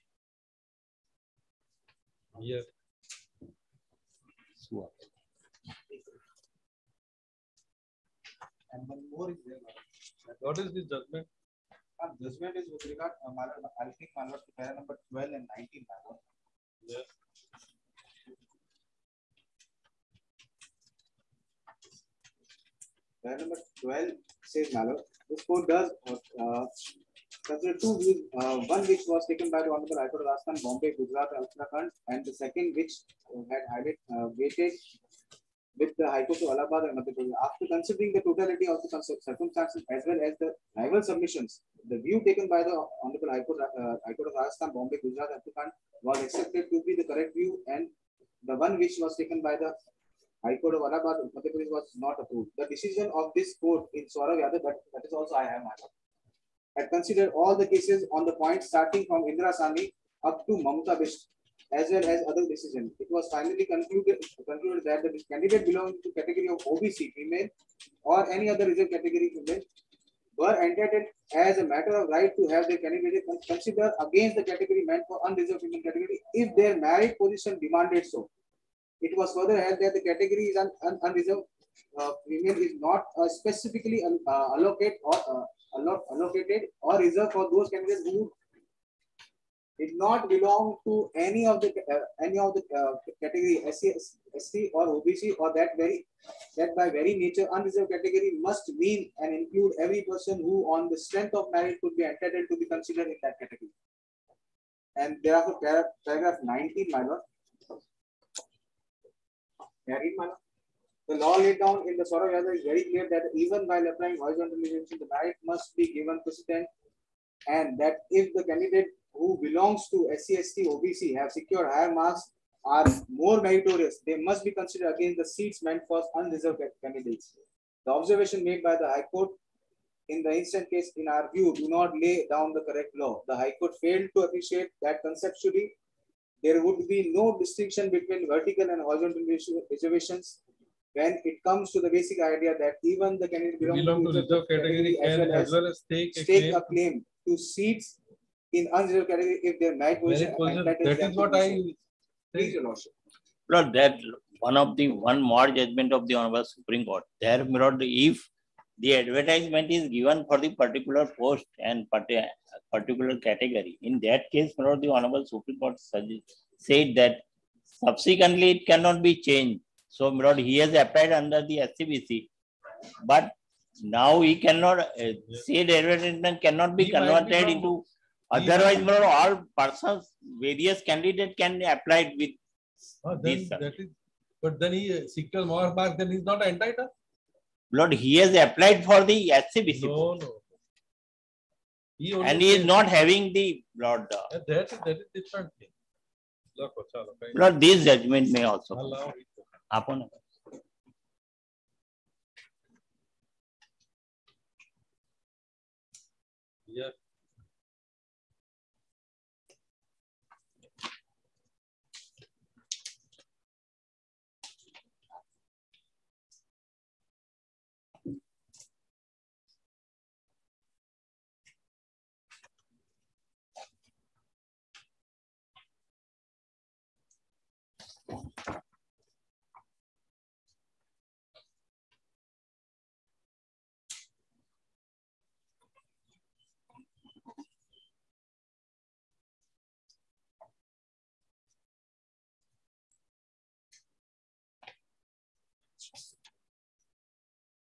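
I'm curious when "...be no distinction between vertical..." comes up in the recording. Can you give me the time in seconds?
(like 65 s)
136 s.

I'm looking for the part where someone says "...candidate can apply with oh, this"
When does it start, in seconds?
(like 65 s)
180 s.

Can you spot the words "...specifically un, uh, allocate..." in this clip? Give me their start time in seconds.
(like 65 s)
83 s.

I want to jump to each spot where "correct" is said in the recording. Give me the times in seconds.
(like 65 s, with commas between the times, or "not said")
47 s, 132 s.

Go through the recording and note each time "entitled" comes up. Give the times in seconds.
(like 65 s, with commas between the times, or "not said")
70 s, 102 s, 186 s.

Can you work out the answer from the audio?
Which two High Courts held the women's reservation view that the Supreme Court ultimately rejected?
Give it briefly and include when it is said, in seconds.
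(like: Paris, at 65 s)
Allahabad and Madhya Pradesh, at 36 s.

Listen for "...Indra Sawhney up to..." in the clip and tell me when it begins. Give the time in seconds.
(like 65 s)
59 s.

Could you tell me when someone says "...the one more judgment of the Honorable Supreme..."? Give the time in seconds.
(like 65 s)
154 s.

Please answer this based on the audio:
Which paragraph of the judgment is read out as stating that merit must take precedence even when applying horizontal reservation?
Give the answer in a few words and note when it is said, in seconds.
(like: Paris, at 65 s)
19, at 106 s.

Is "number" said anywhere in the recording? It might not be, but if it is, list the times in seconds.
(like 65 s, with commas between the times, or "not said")
14 s, 23 s.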